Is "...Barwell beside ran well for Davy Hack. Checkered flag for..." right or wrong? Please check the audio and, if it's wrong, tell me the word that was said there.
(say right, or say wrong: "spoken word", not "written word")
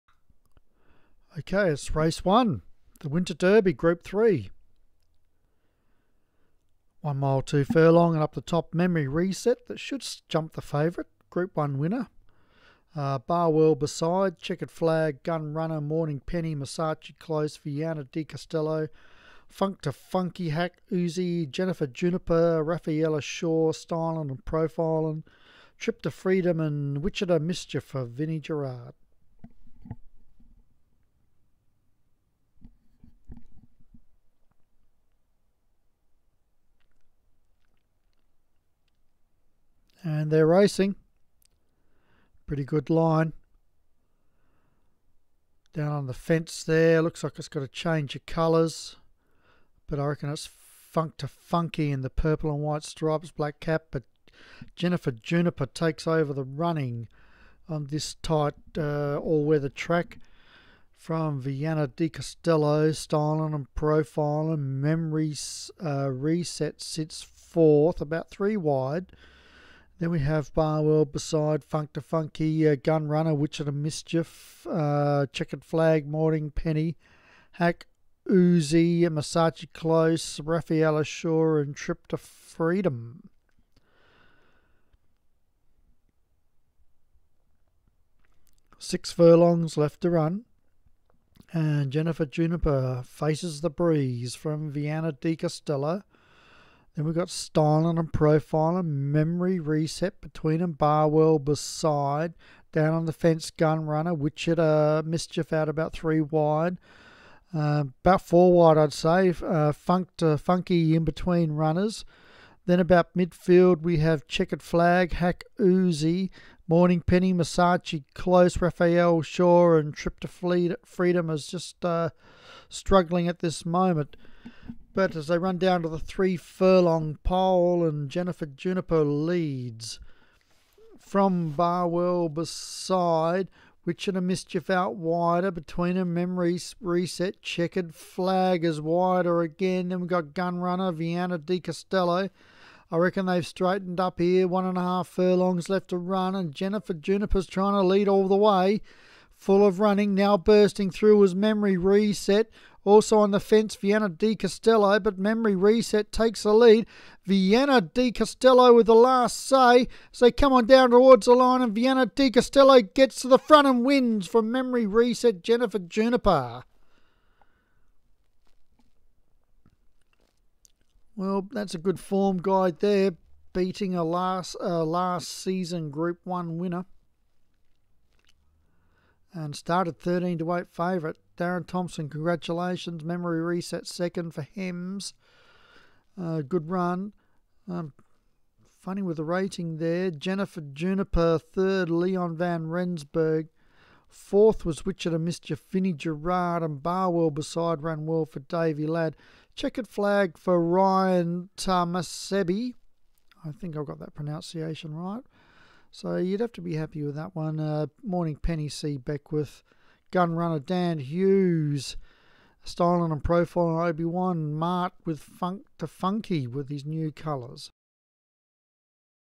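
wrong: "Ladd", not "Hack".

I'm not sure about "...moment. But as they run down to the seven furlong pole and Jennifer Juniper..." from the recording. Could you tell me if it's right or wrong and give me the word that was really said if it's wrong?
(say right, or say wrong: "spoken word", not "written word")
wrong: "three", not "seven".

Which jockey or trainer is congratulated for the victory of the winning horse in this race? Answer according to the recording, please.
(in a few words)
Darren Thompson.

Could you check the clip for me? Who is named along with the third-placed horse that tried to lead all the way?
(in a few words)
Leon Van Rensburg.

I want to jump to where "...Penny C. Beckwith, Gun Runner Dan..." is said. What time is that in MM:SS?
03:28.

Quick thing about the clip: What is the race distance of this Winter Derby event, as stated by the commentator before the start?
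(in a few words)
1 mile 2 furlongs.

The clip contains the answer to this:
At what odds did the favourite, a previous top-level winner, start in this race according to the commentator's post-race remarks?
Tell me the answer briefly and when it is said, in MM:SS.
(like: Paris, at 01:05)
13 to 8, at 02:59.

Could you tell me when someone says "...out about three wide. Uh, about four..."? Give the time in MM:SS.
01:45.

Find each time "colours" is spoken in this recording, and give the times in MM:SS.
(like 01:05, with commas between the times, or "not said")
00:48, 03:37.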